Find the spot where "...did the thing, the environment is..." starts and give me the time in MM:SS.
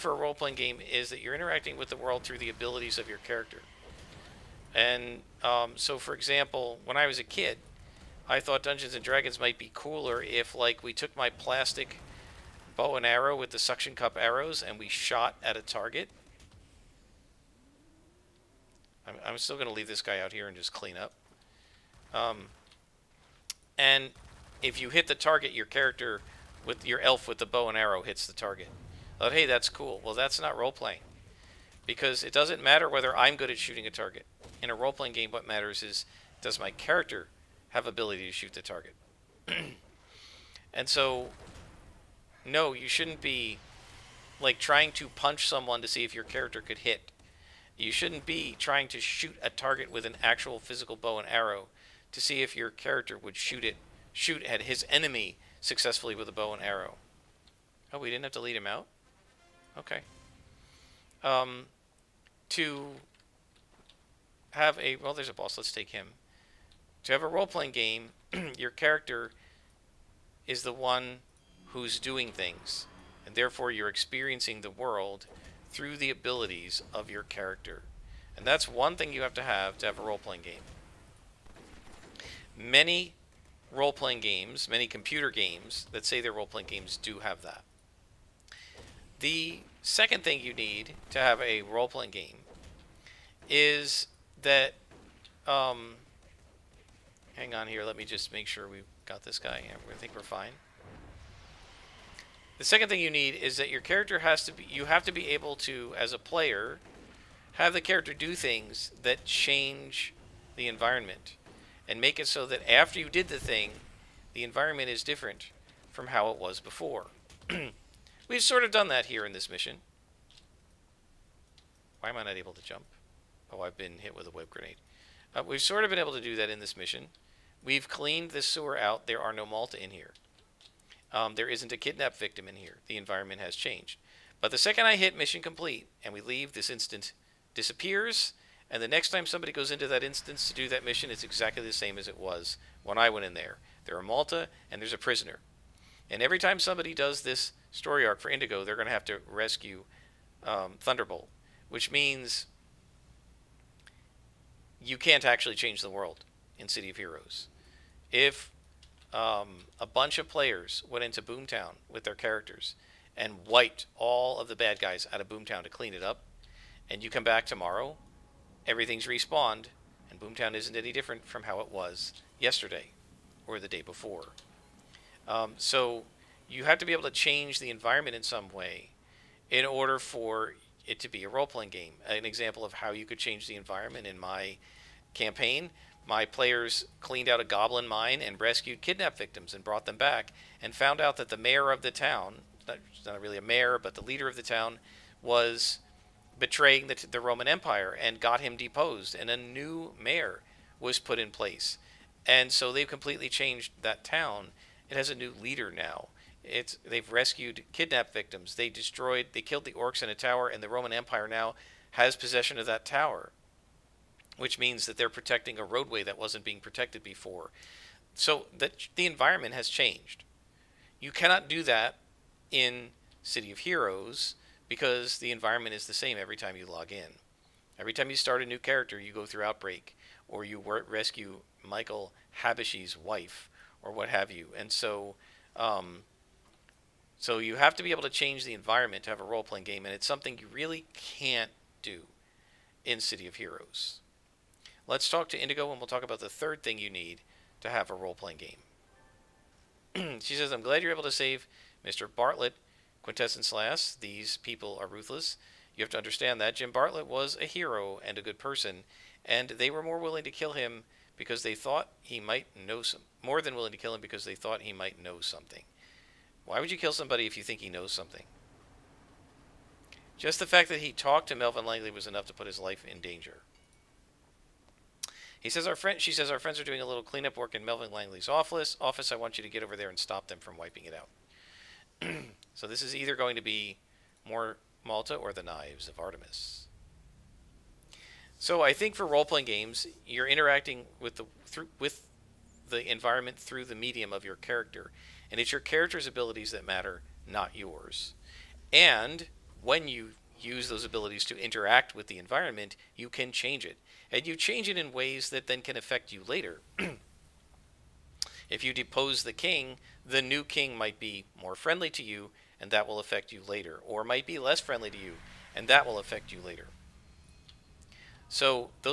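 01:53.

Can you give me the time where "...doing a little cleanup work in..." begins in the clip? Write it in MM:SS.
04:36.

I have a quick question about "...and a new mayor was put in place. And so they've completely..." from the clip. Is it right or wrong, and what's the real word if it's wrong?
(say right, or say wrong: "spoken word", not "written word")
right.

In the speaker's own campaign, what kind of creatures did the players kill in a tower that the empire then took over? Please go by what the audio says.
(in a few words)
orcs.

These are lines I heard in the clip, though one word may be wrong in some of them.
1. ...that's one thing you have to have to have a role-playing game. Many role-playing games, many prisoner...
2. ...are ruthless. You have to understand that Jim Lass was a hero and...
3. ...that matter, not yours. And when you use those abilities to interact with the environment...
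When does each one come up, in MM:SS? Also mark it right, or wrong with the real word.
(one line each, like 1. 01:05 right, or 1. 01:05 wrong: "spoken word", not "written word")
1. 01:18 wrong: "computer", not "prisoner"
2. 04:14 wrong: "Bartlett", not "Lass"
3. 04:56 right.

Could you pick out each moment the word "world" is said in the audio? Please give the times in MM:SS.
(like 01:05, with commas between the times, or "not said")
00:01, 01:14, 02:35.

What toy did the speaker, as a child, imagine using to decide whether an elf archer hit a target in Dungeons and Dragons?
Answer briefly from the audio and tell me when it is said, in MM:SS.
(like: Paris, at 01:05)
plastic bow and arrow, at 00:11.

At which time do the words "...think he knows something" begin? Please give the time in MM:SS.
04:27.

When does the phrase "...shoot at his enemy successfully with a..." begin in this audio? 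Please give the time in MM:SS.
00:54.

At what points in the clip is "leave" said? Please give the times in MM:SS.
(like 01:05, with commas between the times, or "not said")
00:19, 02:16.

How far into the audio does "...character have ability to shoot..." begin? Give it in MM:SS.
00:36.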